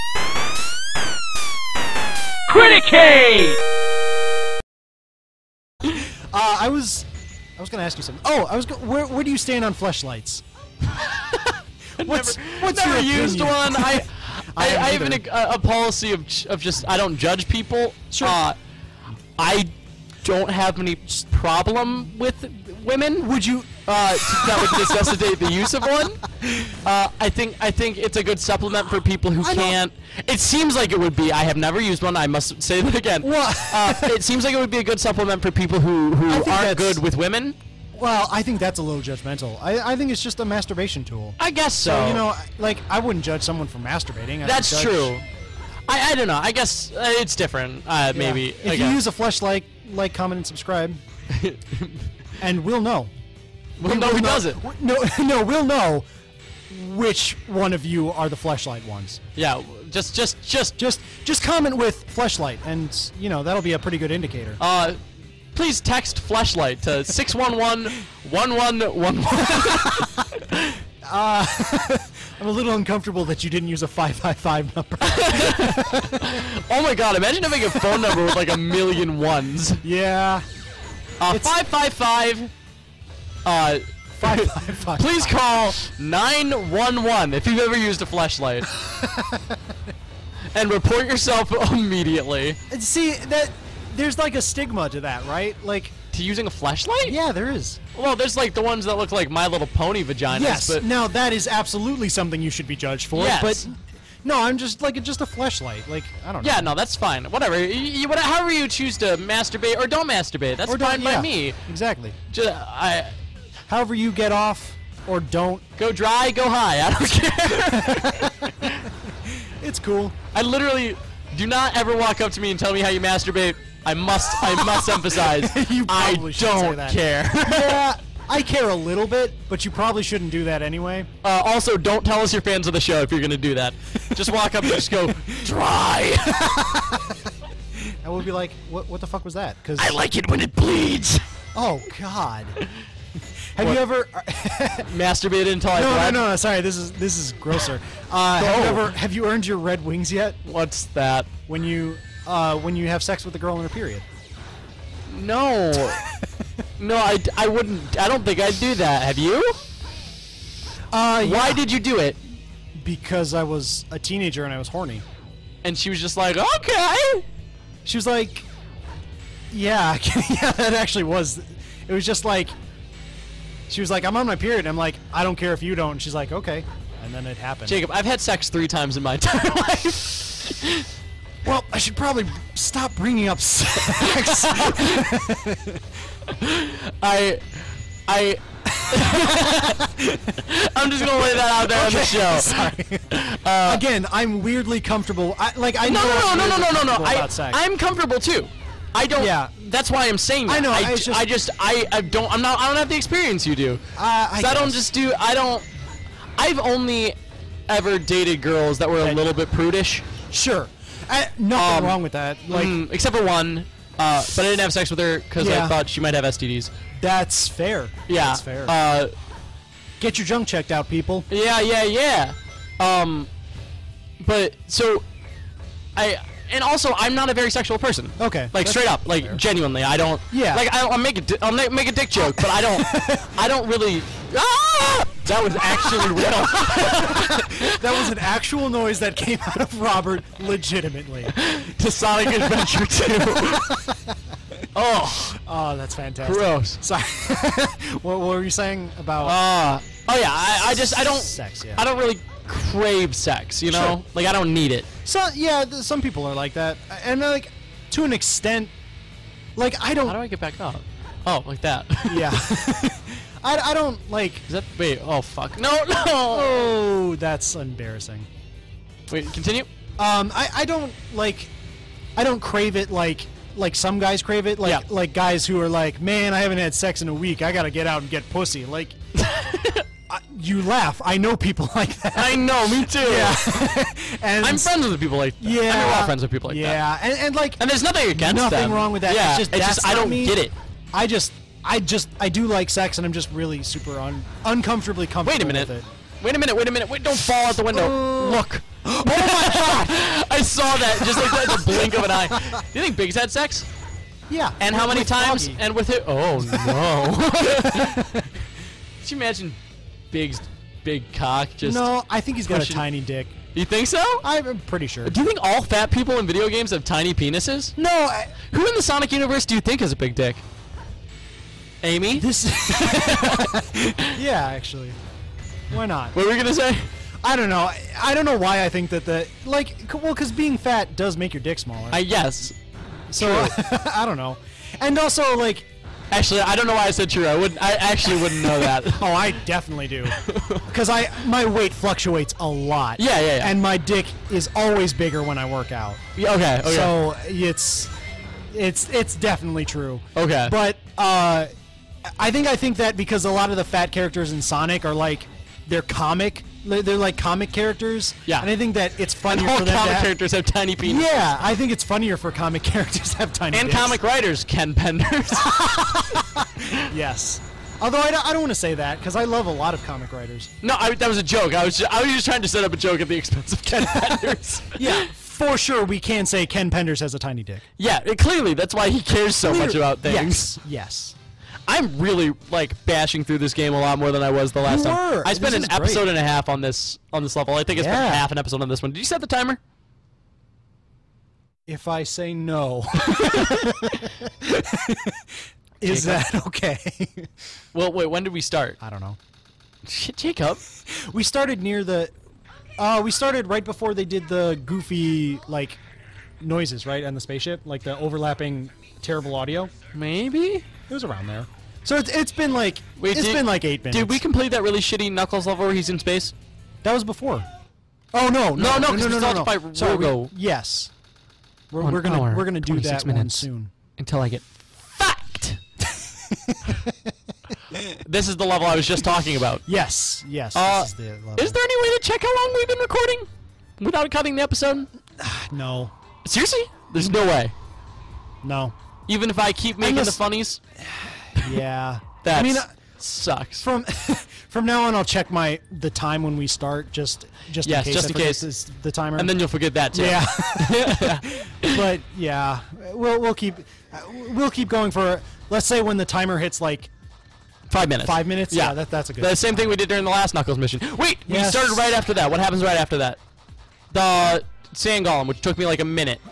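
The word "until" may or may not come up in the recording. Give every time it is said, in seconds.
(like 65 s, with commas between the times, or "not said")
145 s, 423 s.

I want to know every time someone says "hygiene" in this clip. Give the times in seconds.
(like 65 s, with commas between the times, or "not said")
not said.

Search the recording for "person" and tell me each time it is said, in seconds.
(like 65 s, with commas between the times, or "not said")
227 s.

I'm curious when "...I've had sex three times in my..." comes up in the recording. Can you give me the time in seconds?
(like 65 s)
177 s.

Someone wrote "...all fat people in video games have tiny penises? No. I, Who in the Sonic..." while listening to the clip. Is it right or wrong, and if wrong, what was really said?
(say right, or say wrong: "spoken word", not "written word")
right.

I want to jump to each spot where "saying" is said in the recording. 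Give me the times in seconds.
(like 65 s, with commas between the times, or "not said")
200 s, 248 s.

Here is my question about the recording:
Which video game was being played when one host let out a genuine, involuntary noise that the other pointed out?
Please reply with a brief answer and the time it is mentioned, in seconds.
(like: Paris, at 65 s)
Sonic Adventure 2, at 241 s.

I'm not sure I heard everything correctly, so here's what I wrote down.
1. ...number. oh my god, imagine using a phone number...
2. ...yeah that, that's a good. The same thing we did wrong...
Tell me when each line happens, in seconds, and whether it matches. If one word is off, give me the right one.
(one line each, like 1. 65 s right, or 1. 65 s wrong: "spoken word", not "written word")
1. 74 s wrong: "having", not "using"
2. 458 s wrong: "during", not "wrong".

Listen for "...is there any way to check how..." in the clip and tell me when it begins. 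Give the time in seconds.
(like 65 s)
431 s.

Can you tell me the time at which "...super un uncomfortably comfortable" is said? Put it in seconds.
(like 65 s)
293 s.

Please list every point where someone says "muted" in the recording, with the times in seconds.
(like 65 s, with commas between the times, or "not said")
not said.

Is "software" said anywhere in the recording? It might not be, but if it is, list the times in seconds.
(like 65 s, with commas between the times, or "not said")
not said.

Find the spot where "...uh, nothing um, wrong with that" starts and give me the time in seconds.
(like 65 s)
211 s.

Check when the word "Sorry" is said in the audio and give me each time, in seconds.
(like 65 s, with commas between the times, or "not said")
146 s, 192 s, 246 s.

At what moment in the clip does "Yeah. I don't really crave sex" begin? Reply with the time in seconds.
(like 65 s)
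251 s.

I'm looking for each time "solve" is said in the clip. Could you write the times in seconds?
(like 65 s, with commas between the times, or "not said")
not said.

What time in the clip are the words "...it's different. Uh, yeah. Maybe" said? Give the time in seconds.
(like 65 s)
47 s.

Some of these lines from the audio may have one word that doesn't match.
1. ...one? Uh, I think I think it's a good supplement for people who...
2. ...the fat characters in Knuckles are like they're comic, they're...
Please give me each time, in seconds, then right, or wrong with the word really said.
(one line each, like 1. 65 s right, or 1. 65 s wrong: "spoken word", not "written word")
1. 25 s right
2. 353 s wrong: "Sonic", not "Knuckles".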